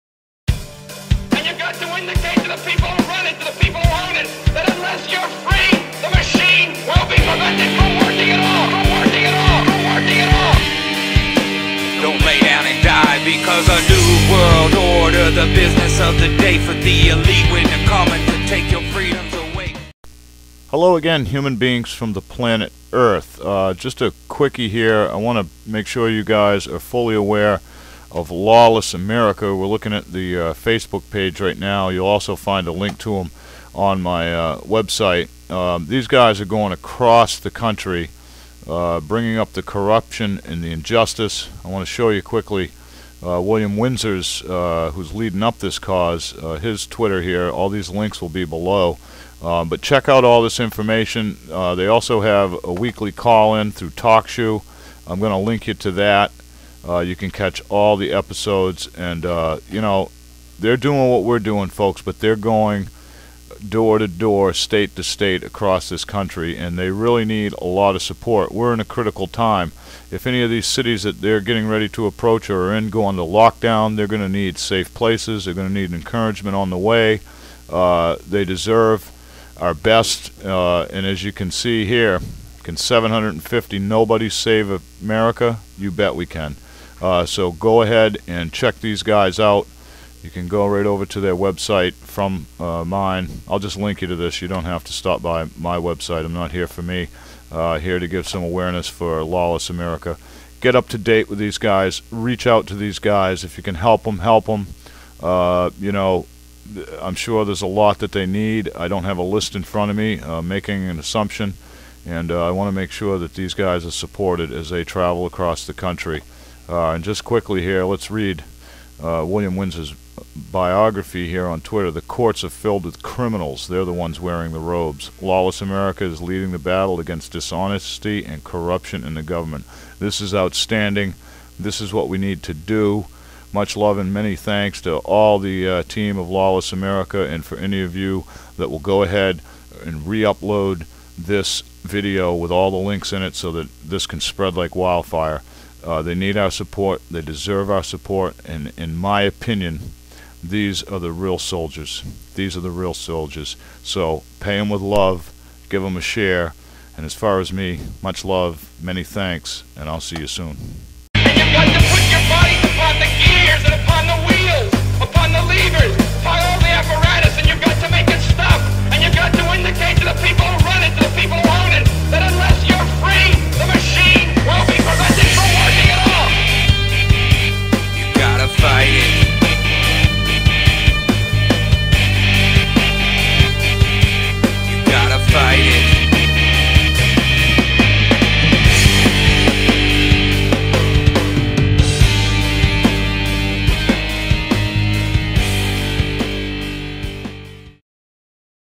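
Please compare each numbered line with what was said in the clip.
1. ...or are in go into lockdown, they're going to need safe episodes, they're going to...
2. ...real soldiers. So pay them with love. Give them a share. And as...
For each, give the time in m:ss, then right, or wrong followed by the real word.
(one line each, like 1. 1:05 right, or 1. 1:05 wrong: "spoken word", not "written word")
1. 1:12 wrong: "places", not "episodes"
2. 2:32 right.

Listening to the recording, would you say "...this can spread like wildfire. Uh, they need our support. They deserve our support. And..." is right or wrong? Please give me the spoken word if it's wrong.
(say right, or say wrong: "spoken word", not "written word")
right.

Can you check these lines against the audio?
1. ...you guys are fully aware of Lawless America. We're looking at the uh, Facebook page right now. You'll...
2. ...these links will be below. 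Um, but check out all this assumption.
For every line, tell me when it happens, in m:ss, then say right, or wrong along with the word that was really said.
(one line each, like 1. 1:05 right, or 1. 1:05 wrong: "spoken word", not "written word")
1. 0:26 right
2. 0:47 wrong: "information", not "assumption".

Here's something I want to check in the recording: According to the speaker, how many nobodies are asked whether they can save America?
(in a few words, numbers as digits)
750.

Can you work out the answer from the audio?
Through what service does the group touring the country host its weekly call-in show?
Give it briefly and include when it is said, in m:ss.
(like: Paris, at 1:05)
TalkShoe, at 0:53.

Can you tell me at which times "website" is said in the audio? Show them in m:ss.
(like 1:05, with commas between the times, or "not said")
0:34, 1:31, 1:35.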